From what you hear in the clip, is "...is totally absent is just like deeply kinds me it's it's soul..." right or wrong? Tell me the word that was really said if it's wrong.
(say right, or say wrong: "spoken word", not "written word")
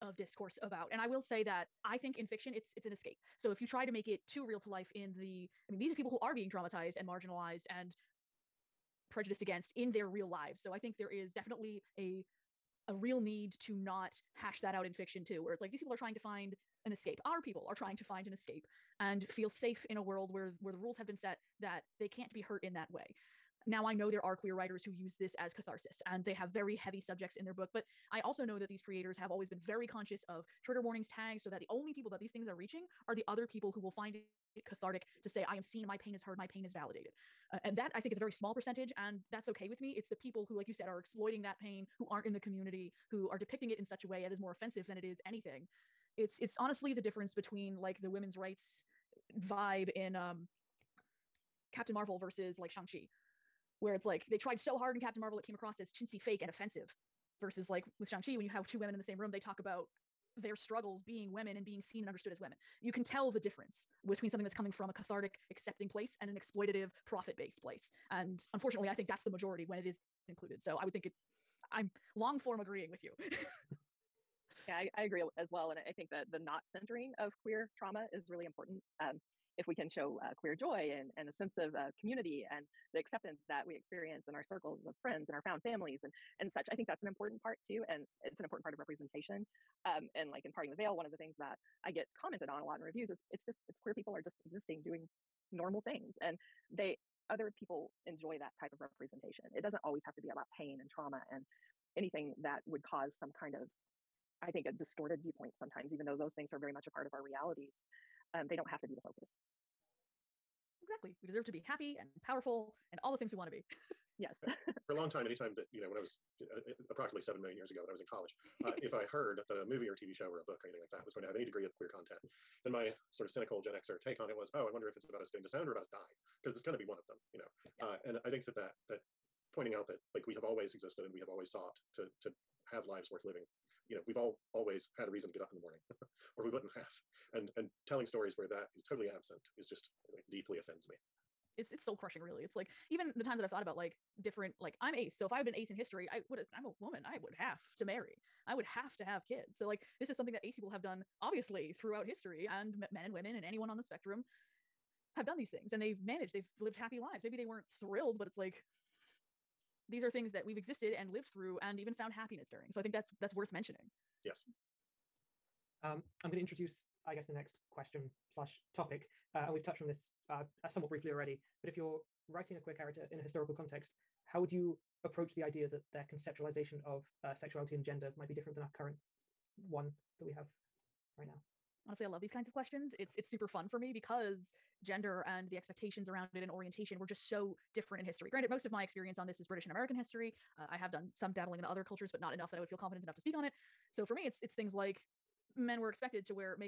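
wrong: "offends", not "kinds".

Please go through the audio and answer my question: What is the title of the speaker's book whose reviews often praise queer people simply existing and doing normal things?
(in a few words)
Parting the Veil.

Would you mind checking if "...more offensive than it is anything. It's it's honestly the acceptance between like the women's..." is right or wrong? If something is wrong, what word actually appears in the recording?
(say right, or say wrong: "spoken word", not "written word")
wrong: "difference", not "acceptance".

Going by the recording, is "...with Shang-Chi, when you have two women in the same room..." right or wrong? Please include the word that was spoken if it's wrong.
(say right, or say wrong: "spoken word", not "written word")
right.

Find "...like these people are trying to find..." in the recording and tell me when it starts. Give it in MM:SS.
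00:15.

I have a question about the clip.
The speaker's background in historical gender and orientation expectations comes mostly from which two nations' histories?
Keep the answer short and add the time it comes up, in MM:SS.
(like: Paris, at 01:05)
British and American, at 03:09.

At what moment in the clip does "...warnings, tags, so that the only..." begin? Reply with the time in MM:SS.
00:30.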